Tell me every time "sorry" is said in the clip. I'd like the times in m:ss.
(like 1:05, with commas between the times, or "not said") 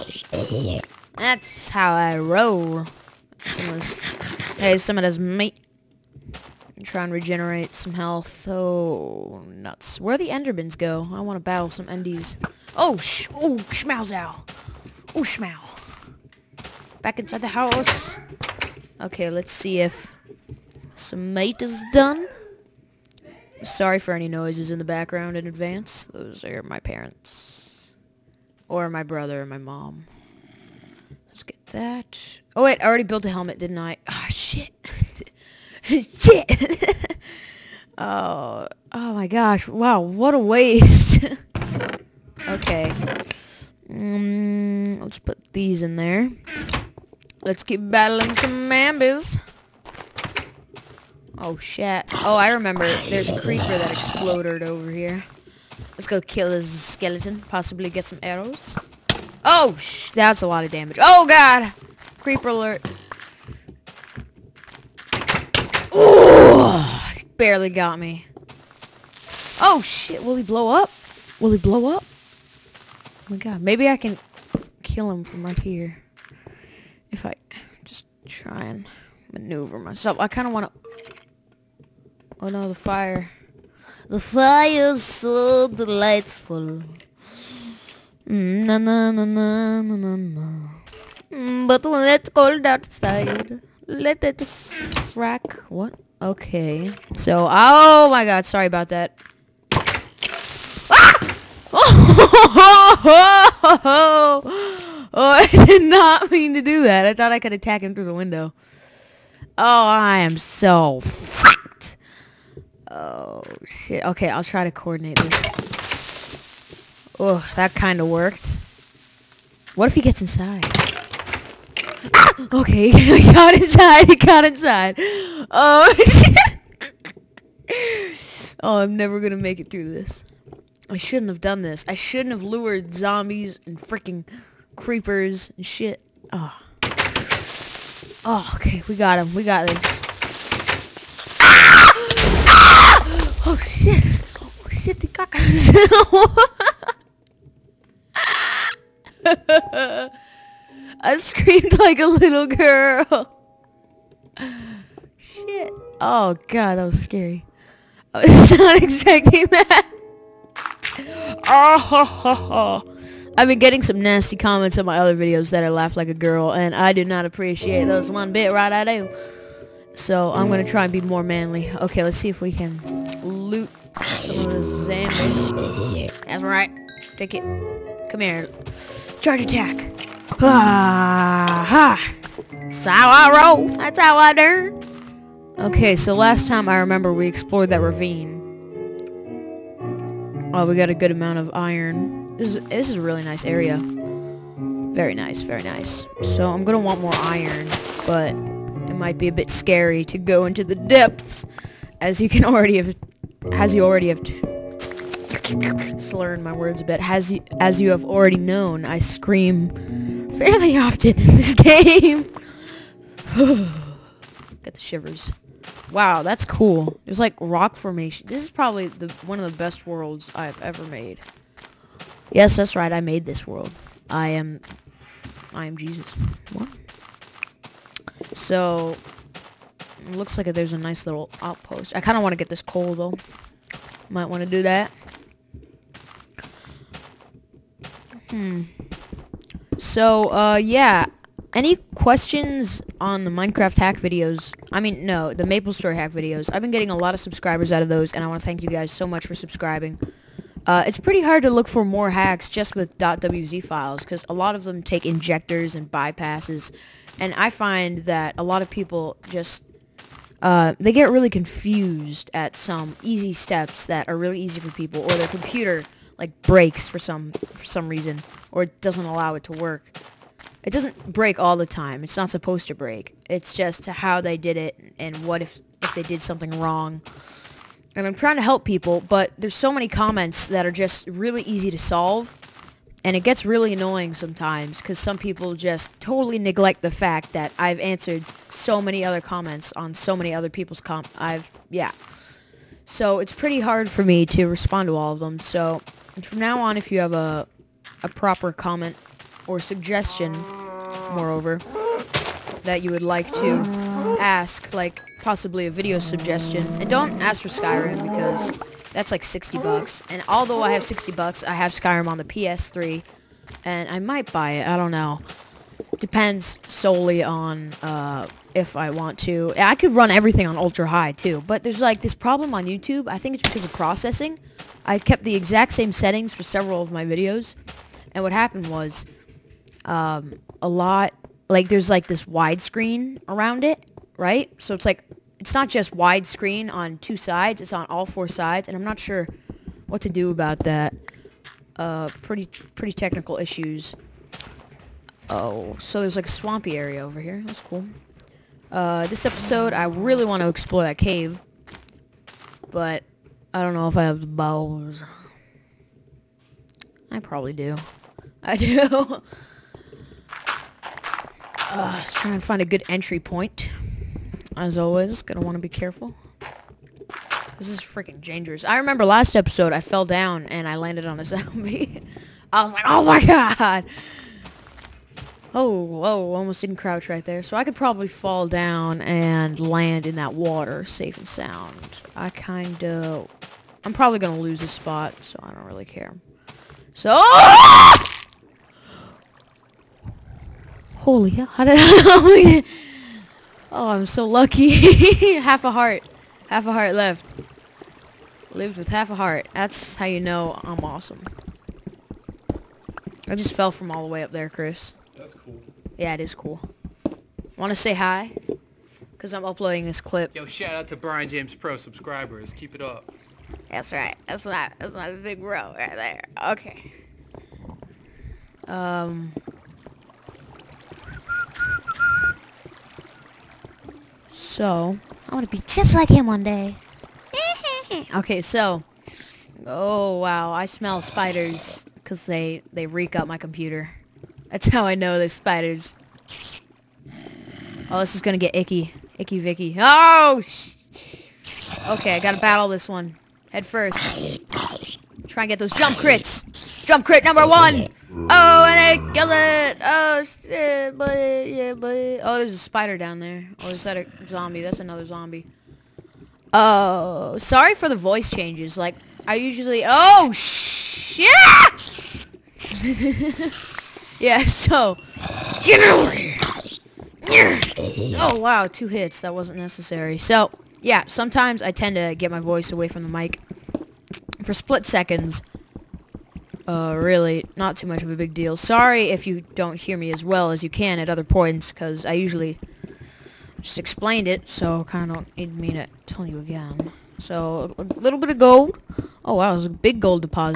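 0:23, 1:38, 7:37, 7:58.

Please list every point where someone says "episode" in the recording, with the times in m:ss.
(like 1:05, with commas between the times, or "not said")
5:49, 6:09.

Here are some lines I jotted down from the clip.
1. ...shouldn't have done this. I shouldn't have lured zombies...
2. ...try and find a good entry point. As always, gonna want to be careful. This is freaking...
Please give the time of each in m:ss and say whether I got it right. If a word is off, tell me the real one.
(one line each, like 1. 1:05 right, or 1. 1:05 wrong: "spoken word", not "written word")
1. 2:10 right
2. 6:02 right.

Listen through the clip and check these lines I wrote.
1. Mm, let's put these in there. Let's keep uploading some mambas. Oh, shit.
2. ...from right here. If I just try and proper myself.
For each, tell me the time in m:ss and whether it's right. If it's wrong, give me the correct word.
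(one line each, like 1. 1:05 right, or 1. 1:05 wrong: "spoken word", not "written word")
1. 0:43 wrong: "battling", not "uploading"
2. 1:15 wrong: "maneuver", not "proper".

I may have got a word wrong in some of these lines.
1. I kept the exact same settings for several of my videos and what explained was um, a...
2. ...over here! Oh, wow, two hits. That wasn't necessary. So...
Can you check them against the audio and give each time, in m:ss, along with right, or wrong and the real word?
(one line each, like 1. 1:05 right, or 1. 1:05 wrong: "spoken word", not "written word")
1. 5:24 wrong: "happened", not "explained"
2. 7:45 right.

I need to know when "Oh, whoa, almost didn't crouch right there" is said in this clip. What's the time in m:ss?
6:15.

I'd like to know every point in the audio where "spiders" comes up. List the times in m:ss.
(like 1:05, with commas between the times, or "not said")
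7:11, 7:15, 7:32.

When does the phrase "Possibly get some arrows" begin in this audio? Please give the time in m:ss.
0:57.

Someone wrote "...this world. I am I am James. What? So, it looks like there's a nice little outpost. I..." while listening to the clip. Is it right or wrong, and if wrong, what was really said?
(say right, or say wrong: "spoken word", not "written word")
wrong: "Jesus", not "James".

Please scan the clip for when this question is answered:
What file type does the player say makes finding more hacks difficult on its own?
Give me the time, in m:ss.
4:12.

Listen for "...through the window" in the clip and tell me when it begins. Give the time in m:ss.
1:47.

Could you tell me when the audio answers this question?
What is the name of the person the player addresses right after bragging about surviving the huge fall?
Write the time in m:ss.
6:44.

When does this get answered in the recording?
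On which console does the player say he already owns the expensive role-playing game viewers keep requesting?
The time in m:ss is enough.
5:12.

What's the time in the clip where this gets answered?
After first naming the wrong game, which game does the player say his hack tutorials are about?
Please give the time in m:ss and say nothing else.
4:05.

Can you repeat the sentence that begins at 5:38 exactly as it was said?
And I'm not sure what to do about that.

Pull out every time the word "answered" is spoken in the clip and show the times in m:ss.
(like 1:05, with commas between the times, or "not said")
4:47.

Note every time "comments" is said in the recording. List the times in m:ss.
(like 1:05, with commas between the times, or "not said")
2:44, 4:39, 4:49, 4:58.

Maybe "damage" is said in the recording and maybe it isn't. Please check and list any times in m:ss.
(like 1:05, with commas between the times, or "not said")
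1:00.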